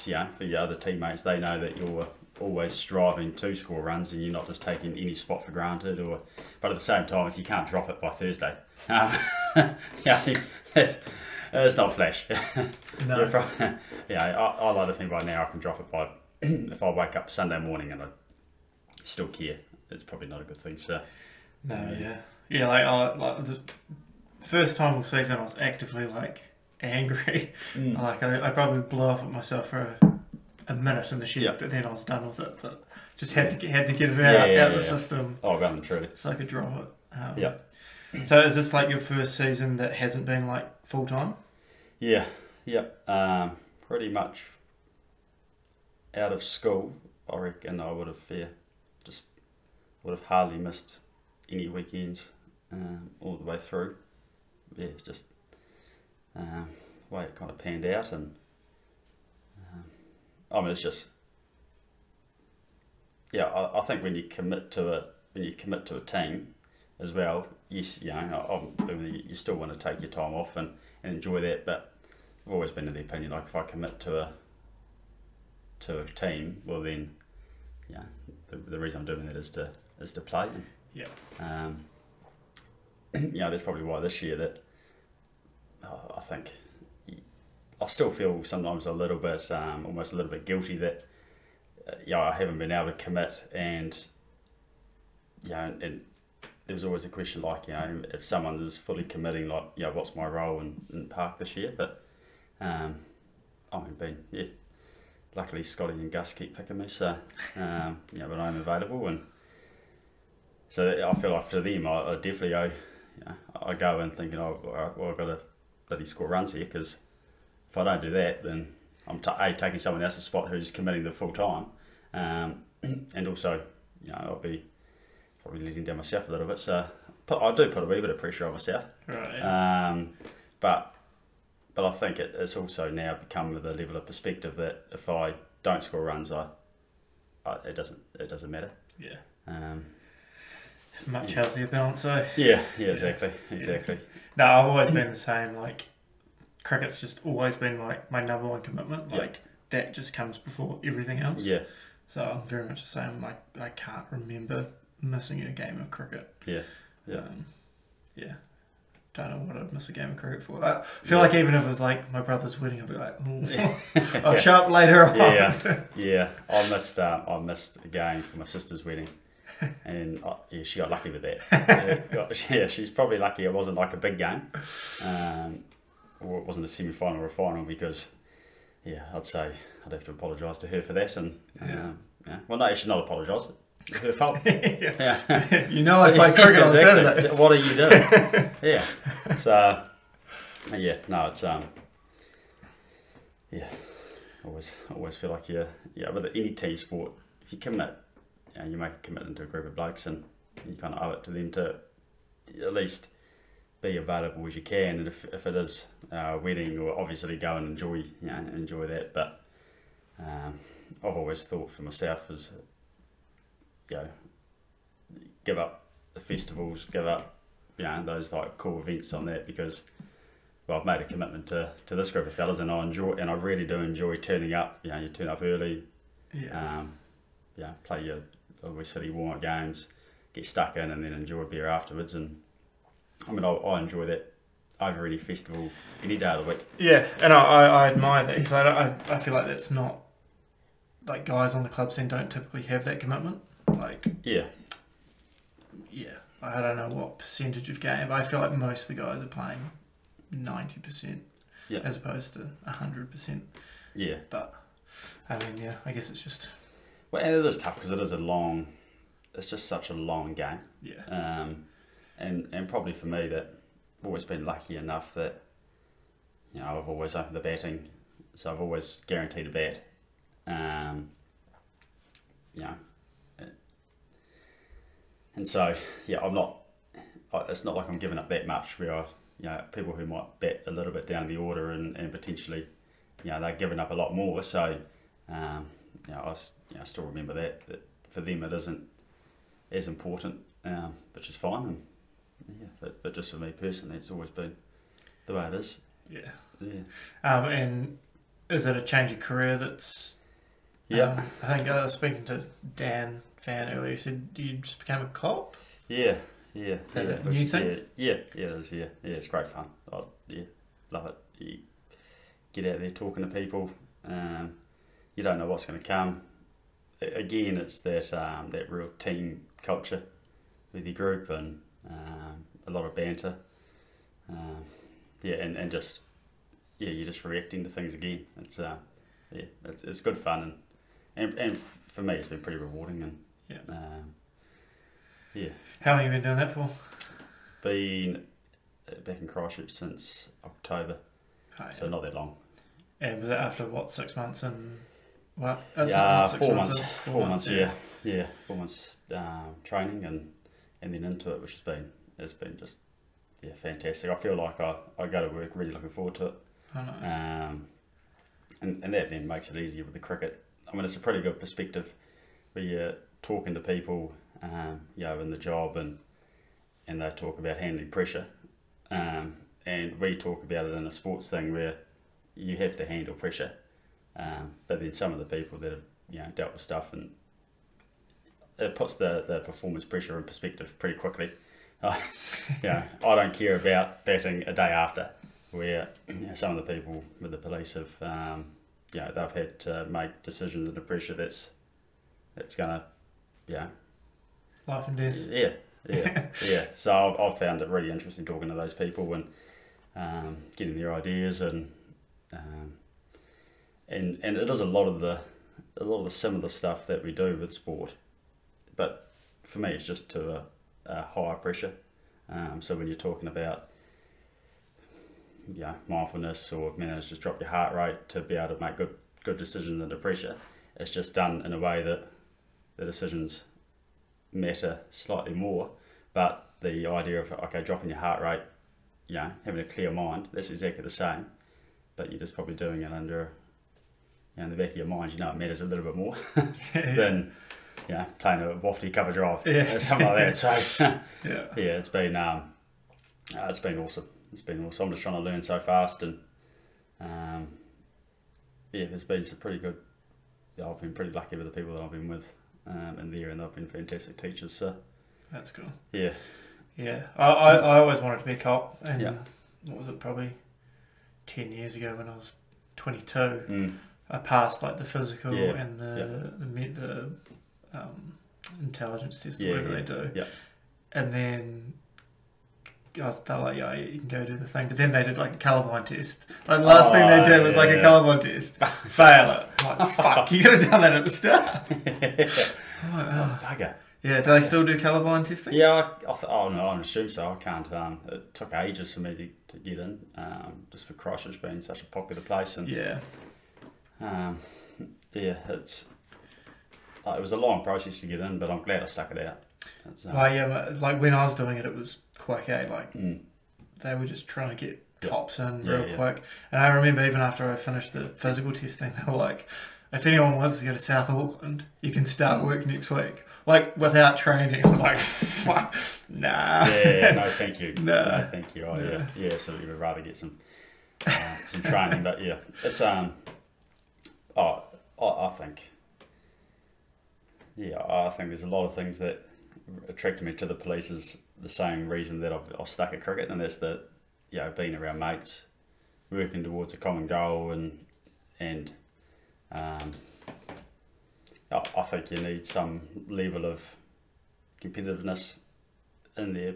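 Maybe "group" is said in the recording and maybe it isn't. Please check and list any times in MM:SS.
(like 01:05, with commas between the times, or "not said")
03:19, 03:42, 05:20.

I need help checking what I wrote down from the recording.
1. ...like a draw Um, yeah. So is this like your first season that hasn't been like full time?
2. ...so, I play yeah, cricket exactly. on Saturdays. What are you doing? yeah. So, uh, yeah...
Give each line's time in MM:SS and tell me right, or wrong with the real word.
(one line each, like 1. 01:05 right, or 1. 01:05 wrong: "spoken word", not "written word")
1. 00:36 right
2. 03:05 right.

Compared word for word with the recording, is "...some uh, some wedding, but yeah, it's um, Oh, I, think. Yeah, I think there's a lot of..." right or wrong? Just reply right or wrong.
wrong.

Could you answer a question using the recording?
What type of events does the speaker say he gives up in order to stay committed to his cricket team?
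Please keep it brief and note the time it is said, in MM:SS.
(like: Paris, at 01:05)
Festivals, at 03:36.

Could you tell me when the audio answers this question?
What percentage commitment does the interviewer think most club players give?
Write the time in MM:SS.
04:10.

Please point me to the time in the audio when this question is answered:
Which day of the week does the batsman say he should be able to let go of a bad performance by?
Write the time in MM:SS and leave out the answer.
00:08.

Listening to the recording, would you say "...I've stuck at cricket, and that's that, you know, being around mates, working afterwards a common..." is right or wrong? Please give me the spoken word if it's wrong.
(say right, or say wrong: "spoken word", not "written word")
wrong: "towards", not "afterwards".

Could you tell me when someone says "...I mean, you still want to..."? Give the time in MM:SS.
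01:08.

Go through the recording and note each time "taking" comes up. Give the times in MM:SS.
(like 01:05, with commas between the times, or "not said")
00:04, 01:59.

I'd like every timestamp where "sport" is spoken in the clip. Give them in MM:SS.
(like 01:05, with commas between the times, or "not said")
03:16, 06:10, 06:47.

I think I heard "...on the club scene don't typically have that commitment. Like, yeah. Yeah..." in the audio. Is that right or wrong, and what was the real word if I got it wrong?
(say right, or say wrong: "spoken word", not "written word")
right.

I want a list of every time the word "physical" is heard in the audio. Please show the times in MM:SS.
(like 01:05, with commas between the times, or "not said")
07:44, 08:28.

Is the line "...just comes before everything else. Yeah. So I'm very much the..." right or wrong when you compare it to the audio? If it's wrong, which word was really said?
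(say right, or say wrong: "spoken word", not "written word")
right.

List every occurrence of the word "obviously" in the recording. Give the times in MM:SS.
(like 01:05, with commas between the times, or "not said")
03:26, 03:48.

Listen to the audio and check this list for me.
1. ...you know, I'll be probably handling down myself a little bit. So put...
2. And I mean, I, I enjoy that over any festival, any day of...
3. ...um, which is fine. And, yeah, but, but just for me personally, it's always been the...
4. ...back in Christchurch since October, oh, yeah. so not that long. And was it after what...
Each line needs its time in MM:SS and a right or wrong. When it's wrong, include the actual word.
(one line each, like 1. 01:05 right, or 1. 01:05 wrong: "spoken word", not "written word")
1. 02:04 wrong: "letting", not "handling"
2. 03:52 right
3. 04:50 right
4. 05:39 right.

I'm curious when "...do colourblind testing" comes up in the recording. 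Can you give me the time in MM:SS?
08:04.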